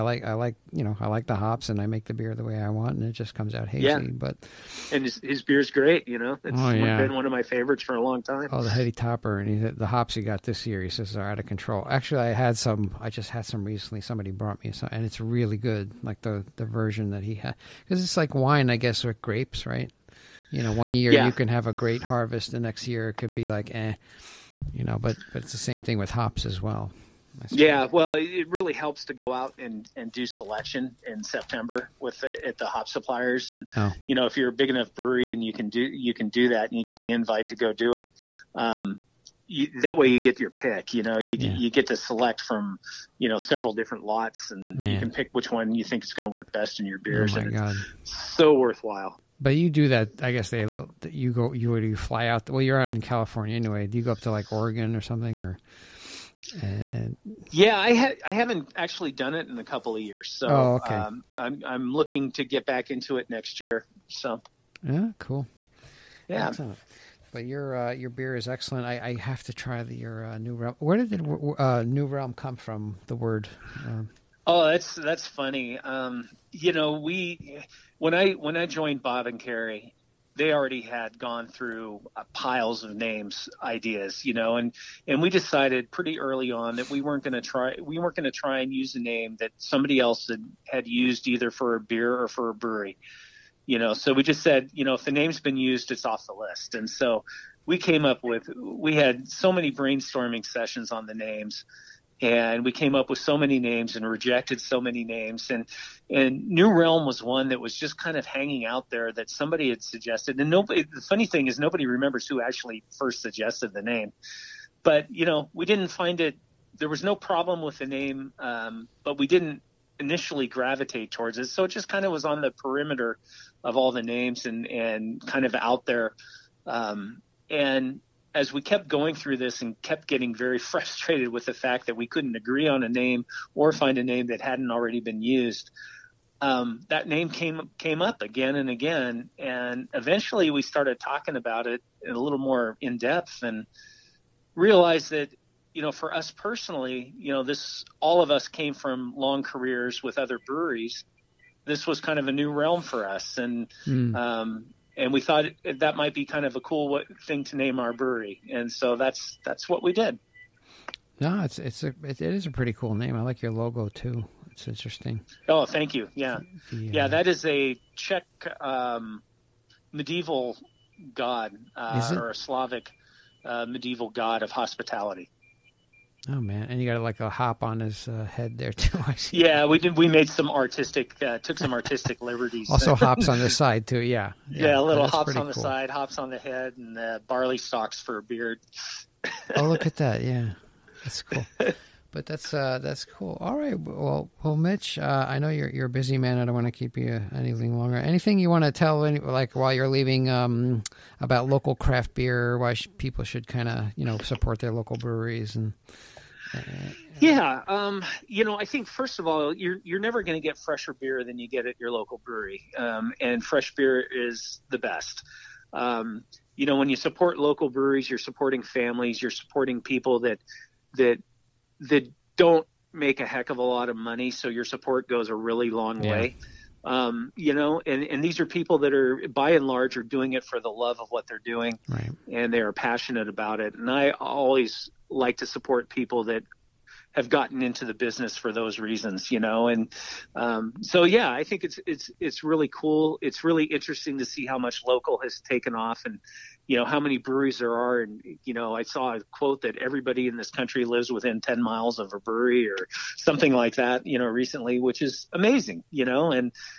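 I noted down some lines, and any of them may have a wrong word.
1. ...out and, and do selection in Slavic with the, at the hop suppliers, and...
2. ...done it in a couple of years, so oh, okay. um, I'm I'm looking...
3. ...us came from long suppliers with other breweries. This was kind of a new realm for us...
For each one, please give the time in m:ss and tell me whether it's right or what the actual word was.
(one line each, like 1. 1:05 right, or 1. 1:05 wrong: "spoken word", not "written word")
1. 0:29 wrong: "September", not "Slavic"
2. 0:59 right
3. 2:28 wrong: "careers", not "suppliers".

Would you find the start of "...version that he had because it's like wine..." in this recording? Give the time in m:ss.
0:16.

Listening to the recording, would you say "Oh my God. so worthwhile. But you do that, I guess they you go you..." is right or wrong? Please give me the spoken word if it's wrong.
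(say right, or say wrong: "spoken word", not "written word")
right.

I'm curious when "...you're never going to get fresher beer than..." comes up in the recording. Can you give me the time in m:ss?
3:29.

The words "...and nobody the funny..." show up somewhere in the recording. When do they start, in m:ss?
1:50.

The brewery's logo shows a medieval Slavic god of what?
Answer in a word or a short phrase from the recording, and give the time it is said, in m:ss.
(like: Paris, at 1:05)
hospitality, at 2:54.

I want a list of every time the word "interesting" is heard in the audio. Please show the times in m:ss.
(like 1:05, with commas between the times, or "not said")
2:44, 4:03.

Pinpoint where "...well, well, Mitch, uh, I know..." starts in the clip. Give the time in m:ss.
3:13.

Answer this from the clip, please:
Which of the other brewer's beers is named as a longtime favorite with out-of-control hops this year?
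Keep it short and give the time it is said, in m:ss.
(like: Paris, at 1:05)
Heady Topper, at 0:08.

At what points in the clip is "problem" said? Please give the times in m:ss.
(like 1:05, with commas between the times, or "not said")
1:57.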